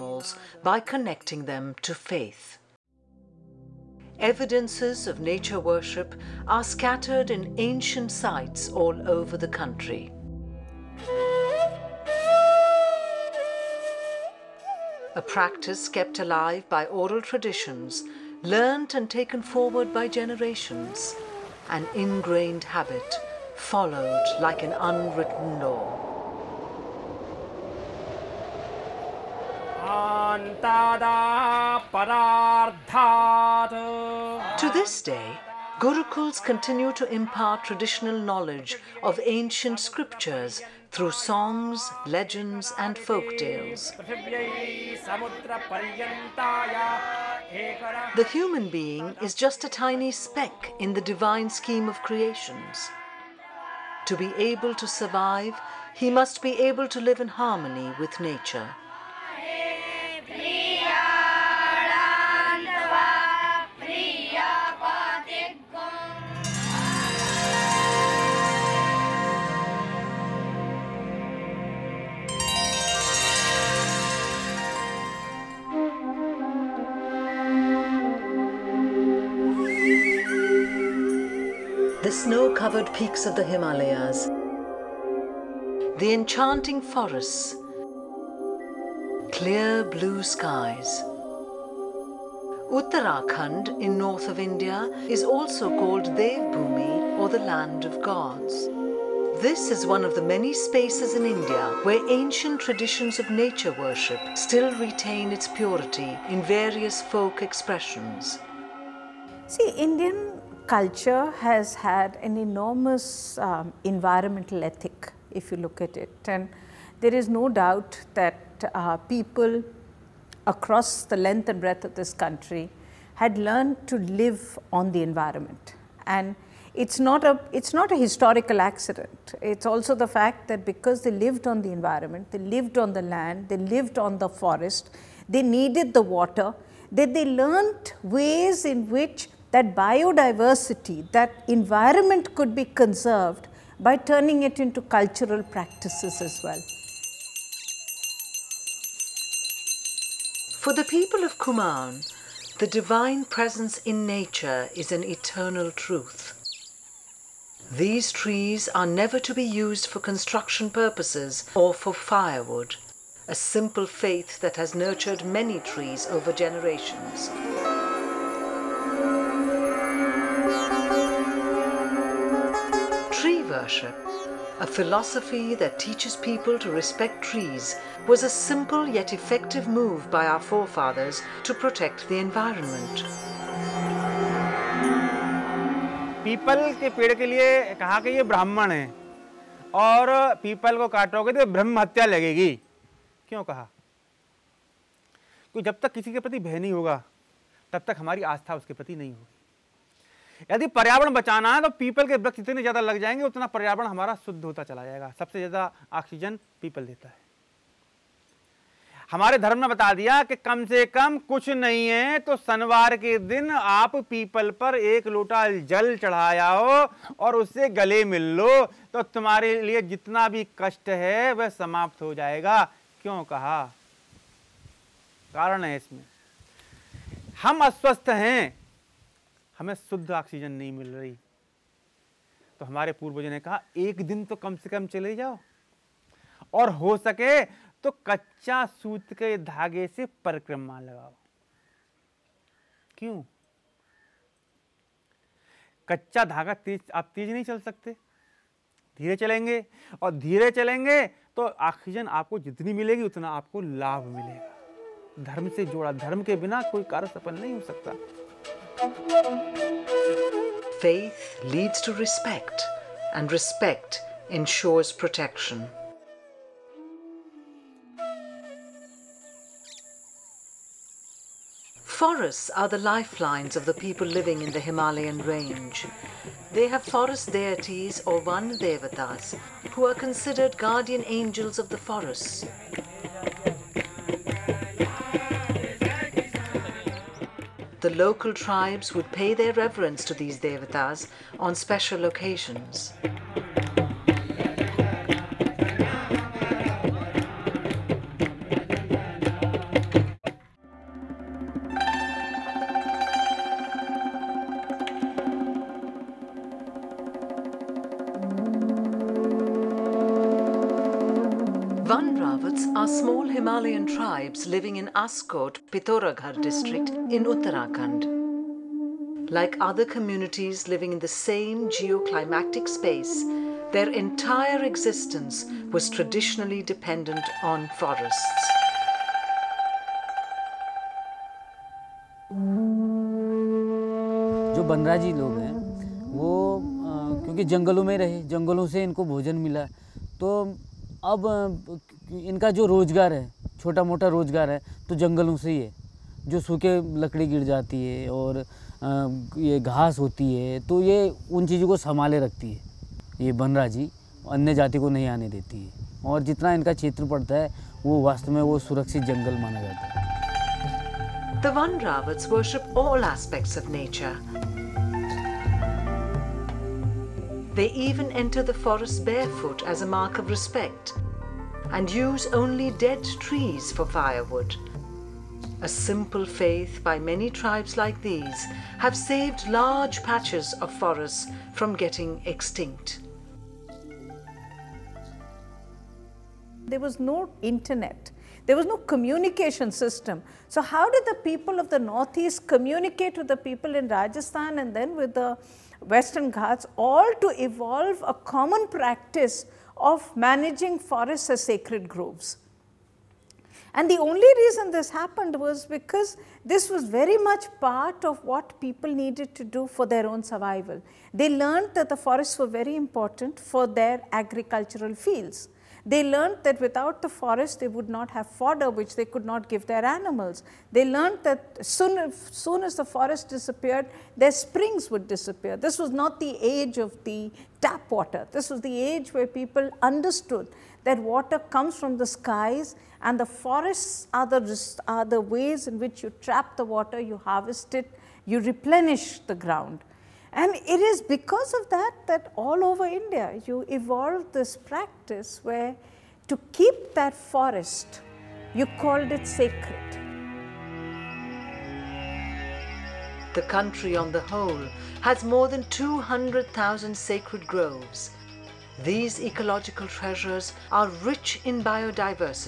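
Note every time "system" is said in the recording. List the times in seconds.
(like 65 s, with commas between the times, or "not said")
389 s.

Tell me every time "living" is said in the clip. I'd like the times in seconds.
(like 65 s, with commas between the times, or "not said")
274 s, 314 s, 320 s.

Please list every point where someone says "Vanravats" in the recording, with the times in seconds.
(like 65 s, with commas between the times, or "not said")
361 s.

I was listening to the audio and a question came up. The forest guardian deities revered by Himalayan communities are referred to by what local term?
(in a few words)
van devatas.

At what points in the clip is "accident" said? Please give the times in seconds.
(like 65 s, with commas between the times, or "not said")
128 s.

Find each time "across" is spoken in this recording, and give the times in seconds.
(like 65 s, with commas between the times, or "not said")
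120 s.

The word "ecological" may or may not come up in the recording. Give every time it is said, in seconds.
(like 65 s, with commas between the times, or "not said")
459 s.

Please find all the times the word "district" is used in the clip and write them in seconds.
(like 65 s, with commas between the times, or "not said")
316 s.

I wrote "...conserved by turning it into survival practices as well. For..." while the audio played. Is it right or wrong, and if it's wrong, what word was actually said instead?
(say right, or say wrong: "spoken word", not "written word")
wrong: "cultural", not "survival".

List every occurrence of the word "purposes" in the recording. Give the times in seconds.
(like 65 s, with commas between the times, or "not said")
160 s.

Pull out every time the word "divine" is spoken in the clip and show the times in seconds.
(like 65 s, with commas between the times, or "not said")
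51 s, 152 s.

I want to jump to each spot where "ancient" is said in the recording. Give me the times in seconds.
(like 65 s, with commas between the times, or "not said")
7 s, 39 s, 102 s.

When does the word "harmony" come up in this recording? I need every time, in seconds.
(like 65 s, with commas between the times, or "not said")
57 s.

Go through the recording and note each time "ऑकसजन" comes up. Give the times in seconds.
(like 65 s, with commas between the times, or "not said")
205 s, 230 s, 251 s.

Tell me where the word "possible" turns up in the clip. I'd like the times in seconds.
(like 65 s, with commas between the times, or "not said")
not said.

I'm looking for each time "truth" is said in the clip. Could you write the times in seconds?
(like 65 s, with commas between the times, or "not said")
155 s.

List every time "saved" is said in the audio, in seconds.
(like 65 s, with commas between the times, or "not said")
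378 s.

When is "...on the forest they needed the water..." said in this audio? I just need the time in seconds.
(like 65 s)
133 s.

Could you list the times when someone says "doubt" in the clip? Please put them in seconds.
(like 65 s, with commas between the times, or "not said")
117 s.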